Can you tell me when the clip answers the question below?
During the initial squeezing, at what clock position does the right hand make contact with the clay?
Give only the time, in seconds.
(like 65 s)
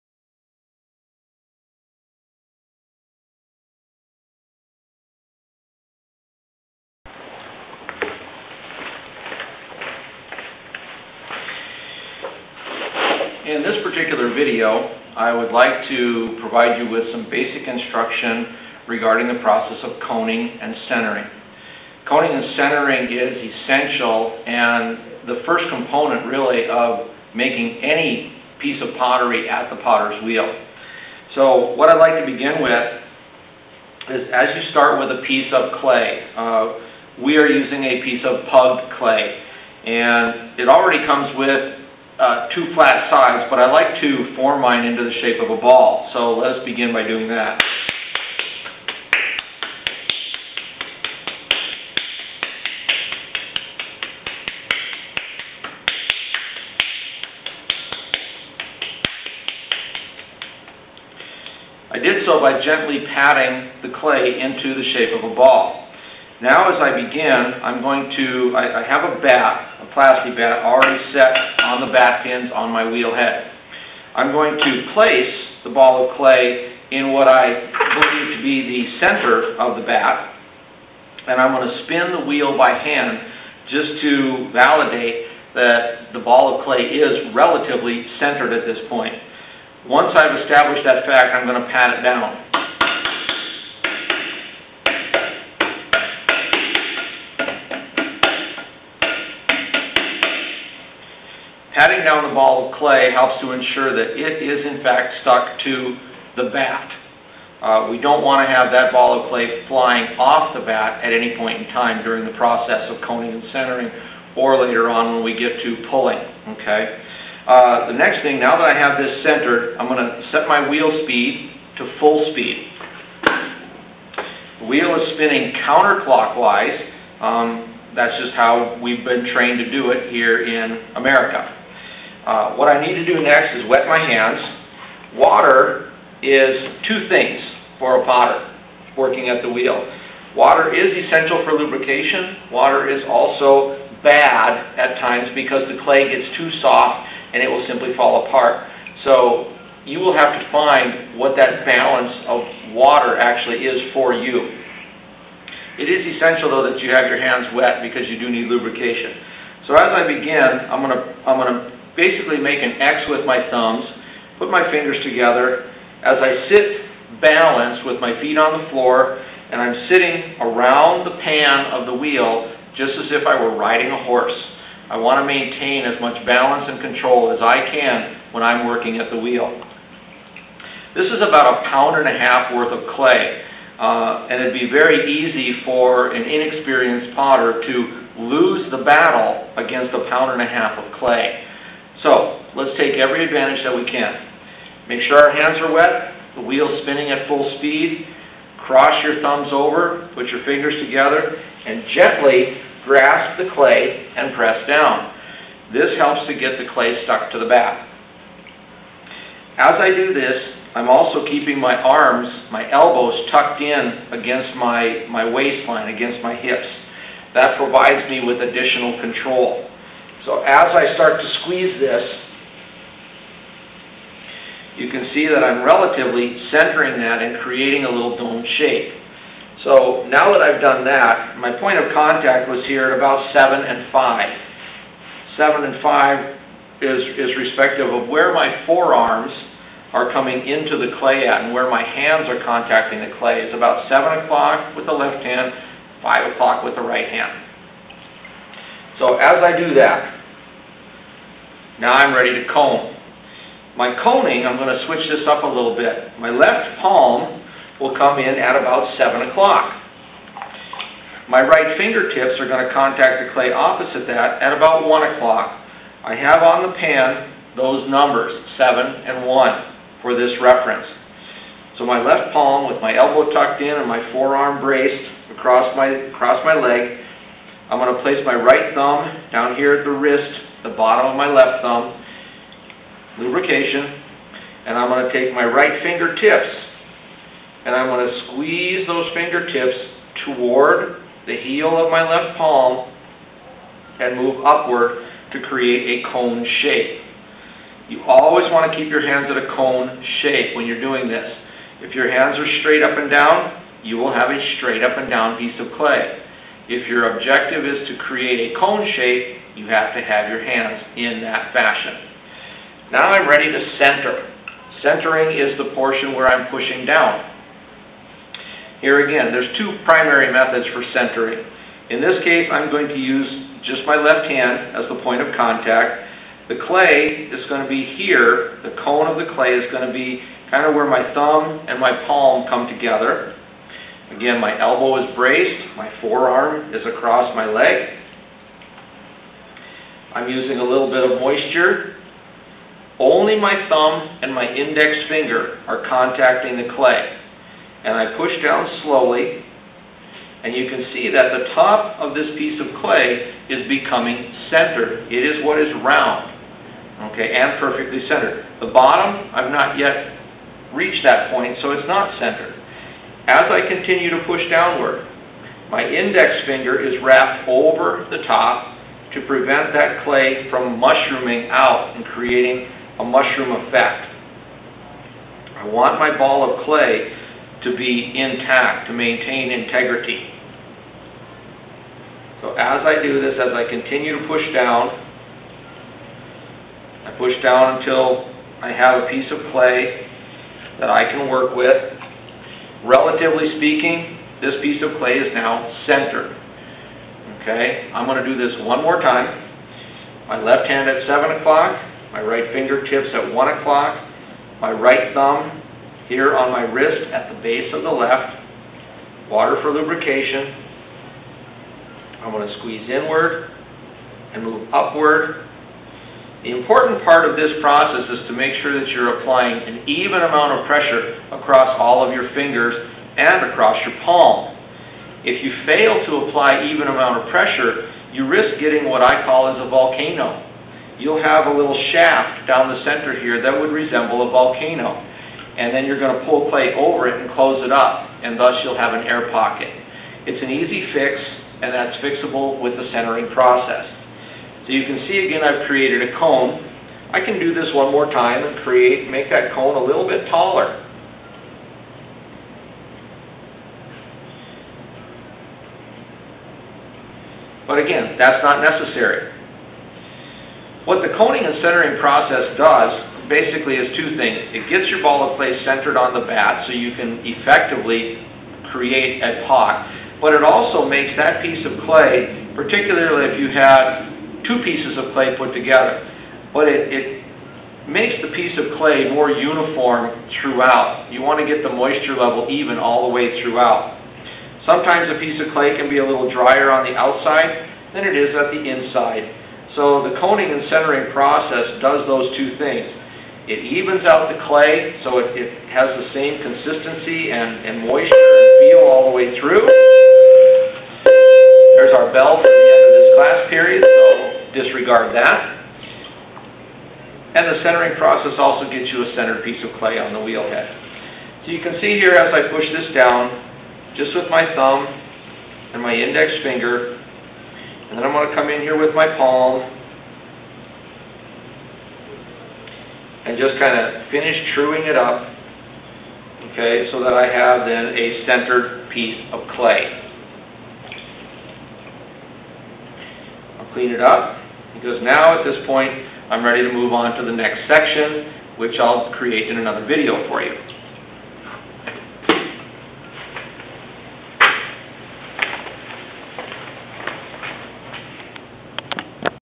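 246 s.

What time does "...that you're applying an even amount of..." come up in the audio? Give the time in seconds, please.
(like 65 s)
418 s.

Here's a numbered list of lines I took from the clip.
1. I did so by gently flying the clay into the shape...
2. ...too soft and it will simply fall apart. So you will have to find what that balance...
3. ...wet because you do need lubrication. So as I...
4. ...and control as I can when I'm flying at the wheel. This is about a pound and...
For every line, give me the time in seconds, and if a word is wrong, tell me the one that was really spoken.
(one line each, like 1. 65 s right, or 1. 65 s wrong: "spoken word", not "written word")
1. 61 s wrong: "patting", not "flying"
2. 146 s right
3. 157 s right
4. 176 s wrong: "working", not "flying".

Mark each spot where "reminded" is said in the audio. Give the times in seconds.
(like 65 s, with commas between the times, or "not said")
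not said.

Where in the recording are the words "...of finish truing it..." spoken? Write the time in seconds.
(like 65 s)
523 s.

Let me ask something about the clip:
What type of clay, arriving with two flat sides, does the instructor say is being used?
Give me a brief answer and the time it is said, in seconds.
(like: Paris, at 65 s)
Pug clay, at 38 s.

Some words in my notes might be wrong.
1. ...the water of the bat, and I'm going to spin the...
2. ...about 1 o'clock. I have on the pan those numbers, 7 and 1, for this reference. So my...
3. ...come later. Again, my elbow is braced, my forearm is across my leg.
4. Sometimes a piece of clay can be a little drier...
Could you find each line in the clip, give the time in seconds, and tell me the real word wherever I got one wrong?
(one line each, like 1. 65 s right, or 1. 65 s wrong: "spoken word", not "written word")
1. 78 s wrong: "center", not "water"
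2. 264 s right
3. 332 s wrong: "together", not "later"
4. 484 s right.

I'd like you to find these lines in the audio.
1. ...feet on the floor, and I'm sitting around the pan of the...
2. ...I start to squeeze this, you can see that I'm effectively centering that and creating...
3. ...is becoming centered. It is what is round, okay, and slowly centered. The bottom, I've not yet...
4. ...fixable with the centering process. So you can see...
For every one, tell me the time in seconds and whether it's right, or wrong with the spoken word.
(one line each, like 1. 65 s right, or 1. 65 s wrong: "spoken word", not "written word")
1. 168 s right
2. 220 s wrong: "relatively", not "effectively"
3. 353 s wrong: "perfectly", not "slowly"
4. 442 s right.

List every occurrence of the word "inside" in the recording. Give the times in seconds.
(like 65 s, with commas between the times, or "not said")
488 s.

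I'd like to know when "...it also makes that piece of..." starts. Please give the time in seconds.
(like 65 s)
470 s.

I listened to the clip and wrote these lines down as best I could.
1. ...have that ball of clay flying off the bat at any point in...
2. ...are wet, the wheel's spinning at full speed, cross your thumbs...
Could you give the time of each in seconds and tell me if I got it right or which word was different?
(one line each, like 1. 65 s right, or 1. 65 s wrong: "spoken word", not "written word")
1. 108 s right
2. 195 s right.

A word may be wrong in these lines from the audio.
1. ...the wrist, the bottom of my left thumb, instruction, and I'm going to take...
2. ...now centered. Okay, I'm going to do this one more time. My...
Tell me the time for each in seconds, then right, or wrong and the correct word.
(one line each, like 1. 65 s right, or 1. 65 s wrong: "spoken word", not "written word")
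1. 279 s wrong: "lubrication", not "instruction"
2. 395 s right.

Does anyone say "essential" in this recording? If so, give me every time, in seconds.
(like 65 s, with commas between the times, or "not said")
23 s, 141 s, 156 s.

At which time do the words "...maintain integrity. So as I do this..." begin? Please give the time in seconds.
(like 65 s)
378 s.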